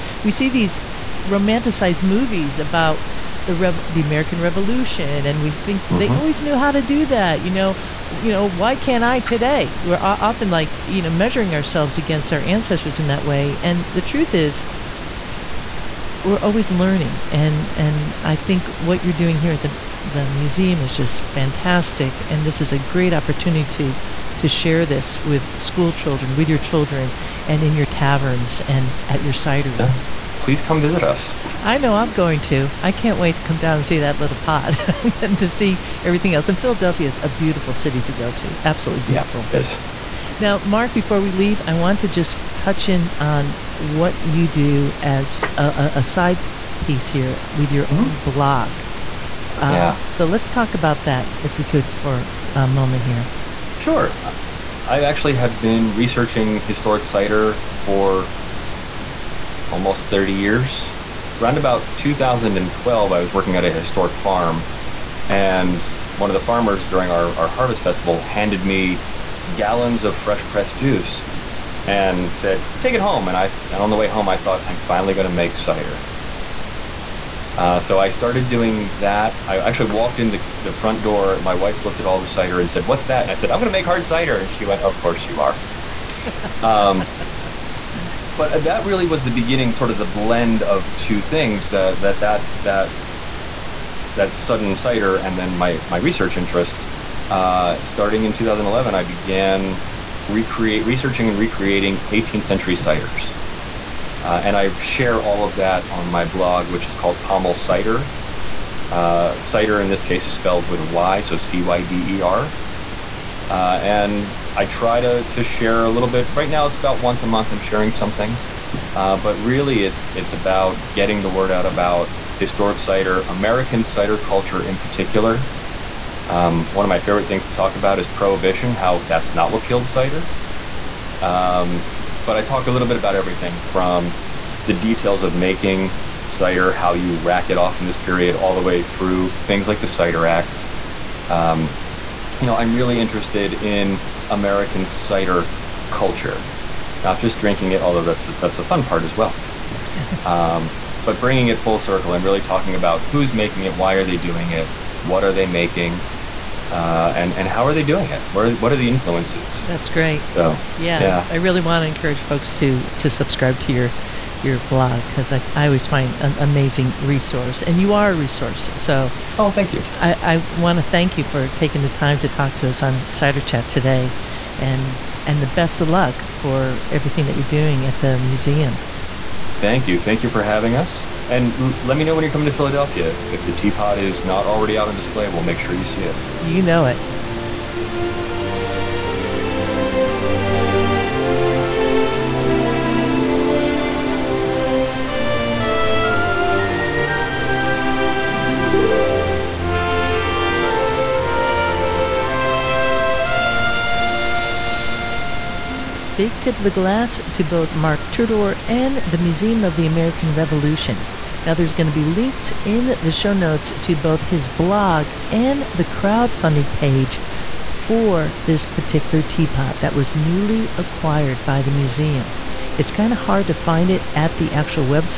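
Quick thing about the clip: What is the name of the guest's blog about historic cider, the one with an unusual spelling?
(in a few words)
Pommel Cyder.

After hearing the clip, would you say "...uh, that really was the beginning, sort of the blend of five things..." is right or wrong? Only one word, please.
wrong.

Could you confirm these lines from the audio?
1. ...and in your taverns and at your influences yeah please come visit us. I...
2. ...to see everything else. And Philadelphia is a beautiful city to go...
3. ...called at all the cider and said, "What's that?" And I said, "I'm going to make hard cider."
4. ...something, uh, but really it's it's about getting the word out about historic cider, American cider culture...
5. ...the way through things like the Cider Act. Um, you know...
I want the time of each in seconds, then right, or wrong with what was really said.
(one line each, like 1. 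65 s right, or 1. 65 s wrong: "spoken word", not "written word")
1. 27 s wrong: "cideries", not "influences"
2. 35 s right
3. 81 s wrong: "looked", not "called"
4. 117 s right
5. 138 s right.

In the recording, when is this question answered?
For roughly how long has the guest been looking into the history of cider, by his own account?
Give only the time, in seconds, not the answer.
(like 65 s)
59 s.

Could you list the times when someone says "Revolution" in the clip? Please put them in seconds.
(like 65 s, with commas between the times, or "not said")
4 s, 210 s.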